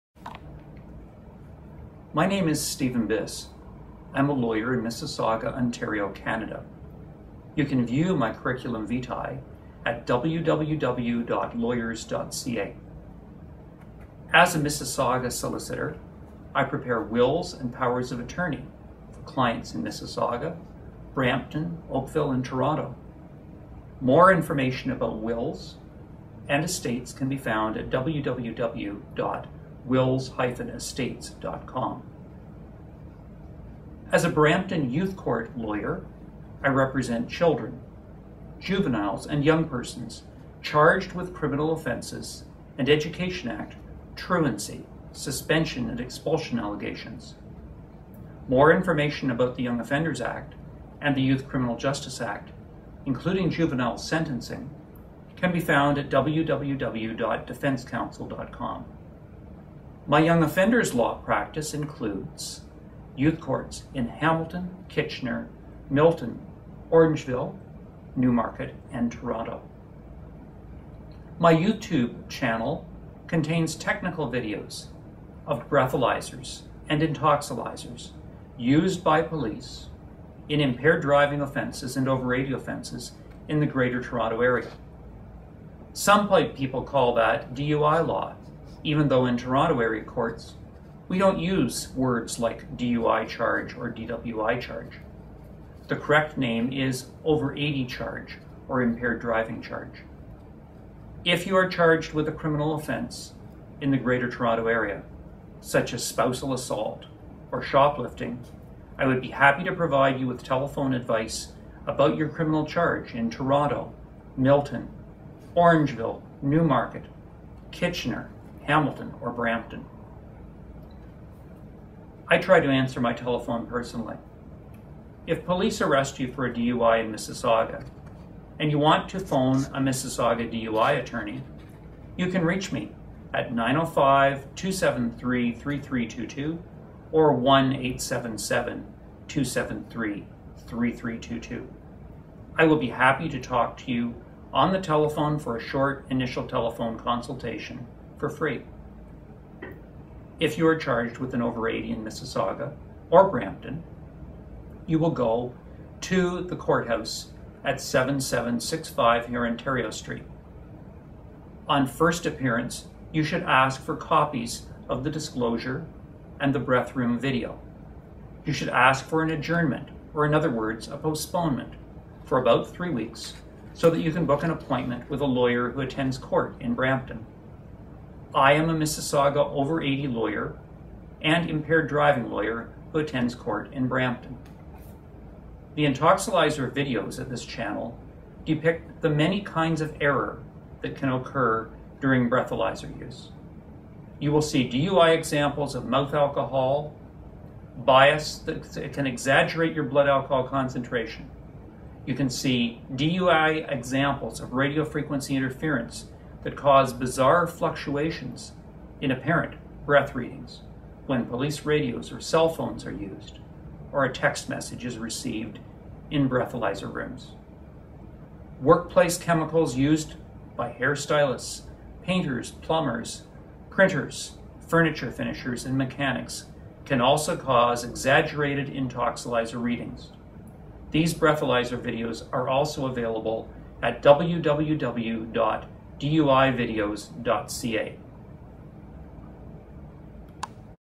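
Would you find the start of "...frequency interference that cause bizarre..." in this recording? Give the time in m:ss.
3:24.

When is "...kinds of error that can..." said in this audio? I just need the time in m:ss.
3:09.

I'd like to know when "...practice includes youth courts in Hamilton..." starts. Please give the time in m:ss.
1:01.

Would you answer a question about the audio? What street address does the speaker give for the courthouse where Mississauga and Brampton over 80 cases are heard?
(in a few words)
7765 Hurontario Street.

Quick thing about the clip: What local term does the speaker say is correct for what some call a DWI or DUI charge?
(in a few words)
over 80 charge.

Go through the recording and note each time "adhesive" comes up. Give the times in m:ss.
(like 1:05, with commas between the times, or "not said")
not said.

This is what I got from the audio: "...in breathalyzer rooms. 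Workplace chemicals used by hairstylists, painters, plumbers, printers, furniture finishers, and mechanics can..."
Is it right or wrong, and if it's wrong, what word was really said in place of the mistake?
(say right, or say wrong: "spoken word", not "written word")
right.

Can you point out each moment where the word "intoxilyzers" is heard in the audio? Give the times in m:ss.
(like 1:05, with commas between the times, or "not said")
1:17, 3:05, 3:48.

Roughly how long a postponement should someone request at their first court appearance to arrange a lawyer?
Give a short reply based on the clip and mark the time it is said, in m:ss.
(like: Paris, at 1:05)
about three weeks, at 2:52.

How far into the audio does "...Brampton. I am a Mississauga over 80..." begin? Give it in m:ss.
2:56.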